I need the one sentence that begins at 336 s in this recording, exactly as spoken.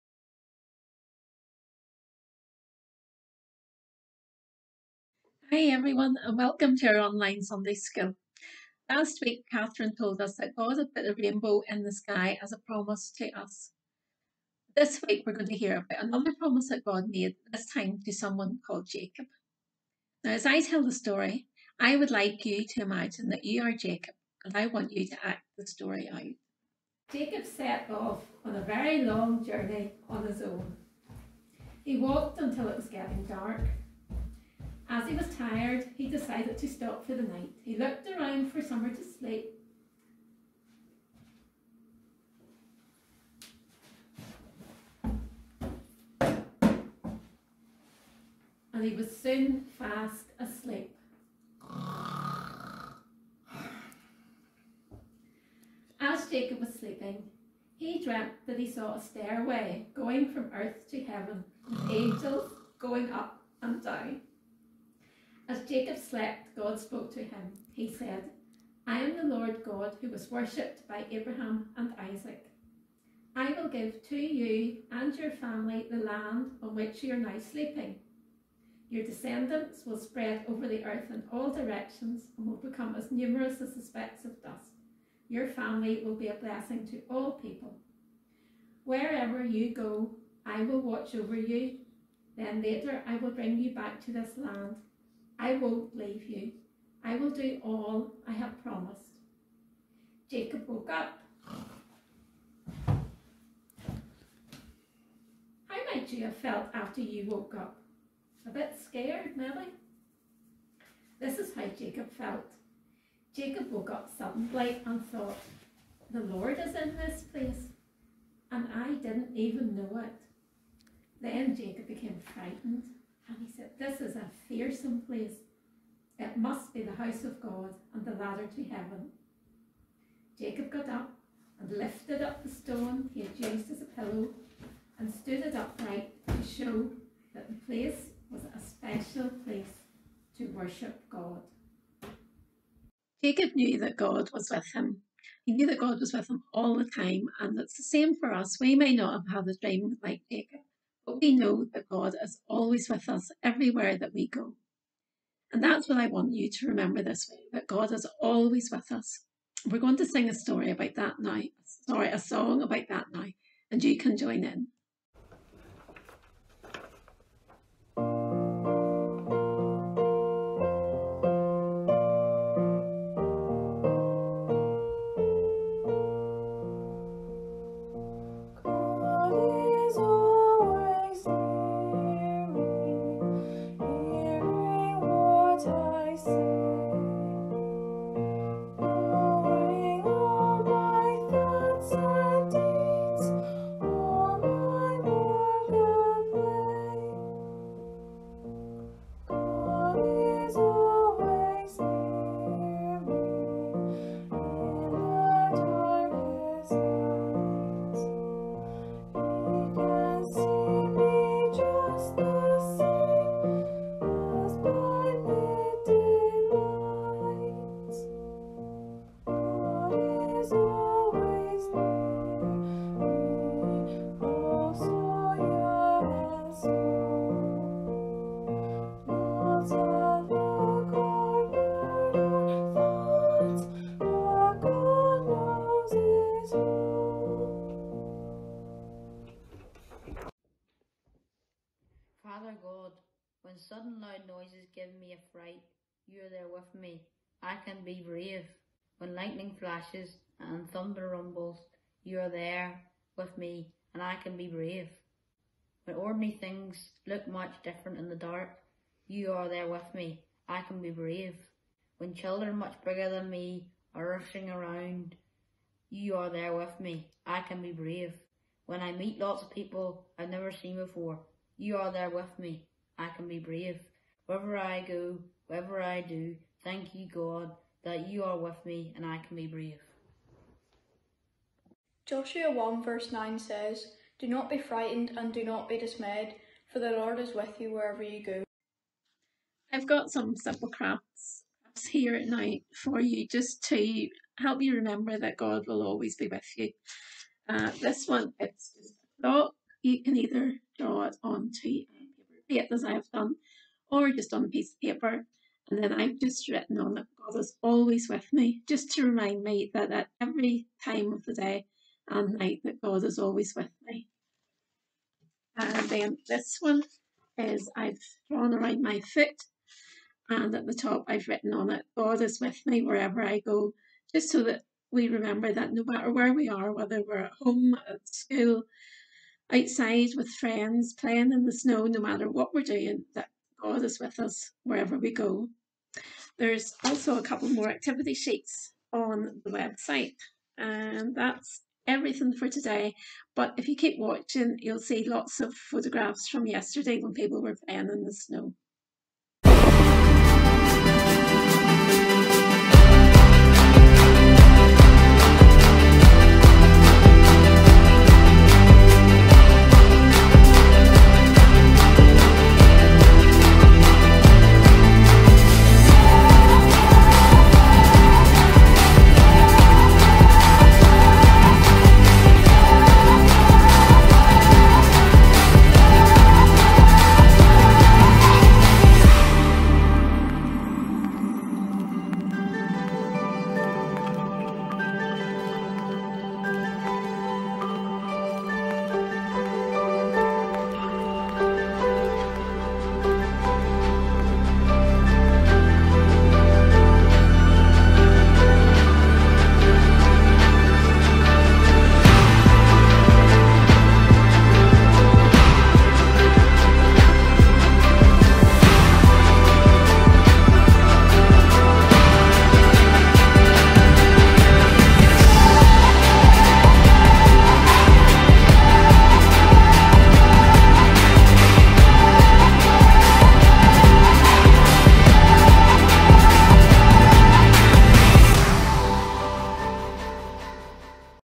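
There's also a couple more activity sheets on the website, and that's everything for today.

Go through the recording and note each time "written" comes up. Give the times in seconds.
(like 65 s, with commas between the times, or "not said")
306 s, 321 s.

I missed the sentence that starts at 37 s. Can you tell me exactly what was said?
He looked around for somewhere to sleep.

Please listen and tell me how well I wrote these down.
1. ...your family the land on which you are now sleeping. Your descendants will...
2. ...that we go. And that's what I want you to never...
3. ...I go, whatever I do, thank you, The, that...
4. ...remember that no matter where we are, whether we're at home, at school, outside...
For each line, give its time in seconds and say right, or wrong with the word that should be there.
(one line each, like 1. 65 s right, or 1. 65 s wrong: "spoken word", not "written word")
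1. 75 s right
2. 153 s wrong: "remember", not "never"
3. 274 s wrong: "God", not "The"
4. 325 s right.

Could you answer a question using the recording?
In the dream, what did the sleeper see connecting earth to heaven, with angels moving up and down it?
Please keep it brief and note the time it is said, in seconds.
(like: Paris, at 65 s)
A stairway, at 59 s.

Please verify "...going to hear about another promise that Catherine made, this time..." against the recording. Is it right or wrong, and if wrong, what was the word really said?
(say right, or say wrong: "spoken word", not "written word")
wrong: "God", not "Catherine".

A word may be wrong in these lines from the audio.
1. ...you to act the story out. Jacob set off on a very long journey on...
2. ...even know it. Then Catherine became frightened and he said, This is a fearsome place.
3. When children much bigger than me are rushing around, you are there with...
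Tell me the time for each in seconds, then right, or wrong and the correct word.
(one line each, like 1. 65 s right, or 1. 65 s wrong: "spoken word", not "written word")
1. 24 s right
2. 119 s wrong: "Jacob", not "Catherine"
3. 261 s right.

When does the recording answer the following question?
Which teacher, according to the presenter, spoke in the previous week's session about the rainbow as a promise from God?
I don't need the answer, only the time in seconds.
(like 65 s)
9 s.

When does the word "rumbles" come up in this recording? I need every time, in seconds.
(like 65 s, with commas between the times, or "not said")
251 s.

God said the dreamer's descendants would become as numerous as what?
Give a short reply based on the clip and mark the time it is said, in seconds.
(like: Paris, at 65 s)
Specks of dust, at 83 s.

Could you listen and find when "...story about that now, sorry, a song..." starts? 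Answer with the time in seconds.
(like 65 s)
160 s.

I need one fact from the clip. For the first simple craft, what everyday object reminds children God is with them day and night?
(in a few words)
A clock.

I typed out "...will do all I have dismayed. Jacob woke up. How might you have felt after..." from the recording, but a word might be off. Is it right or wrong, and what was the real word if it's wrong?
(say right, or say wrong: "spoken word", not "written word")
wrong: "promised", not "dismayed".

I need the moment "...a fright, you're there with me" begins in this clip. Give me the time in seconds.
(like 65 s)
245 s.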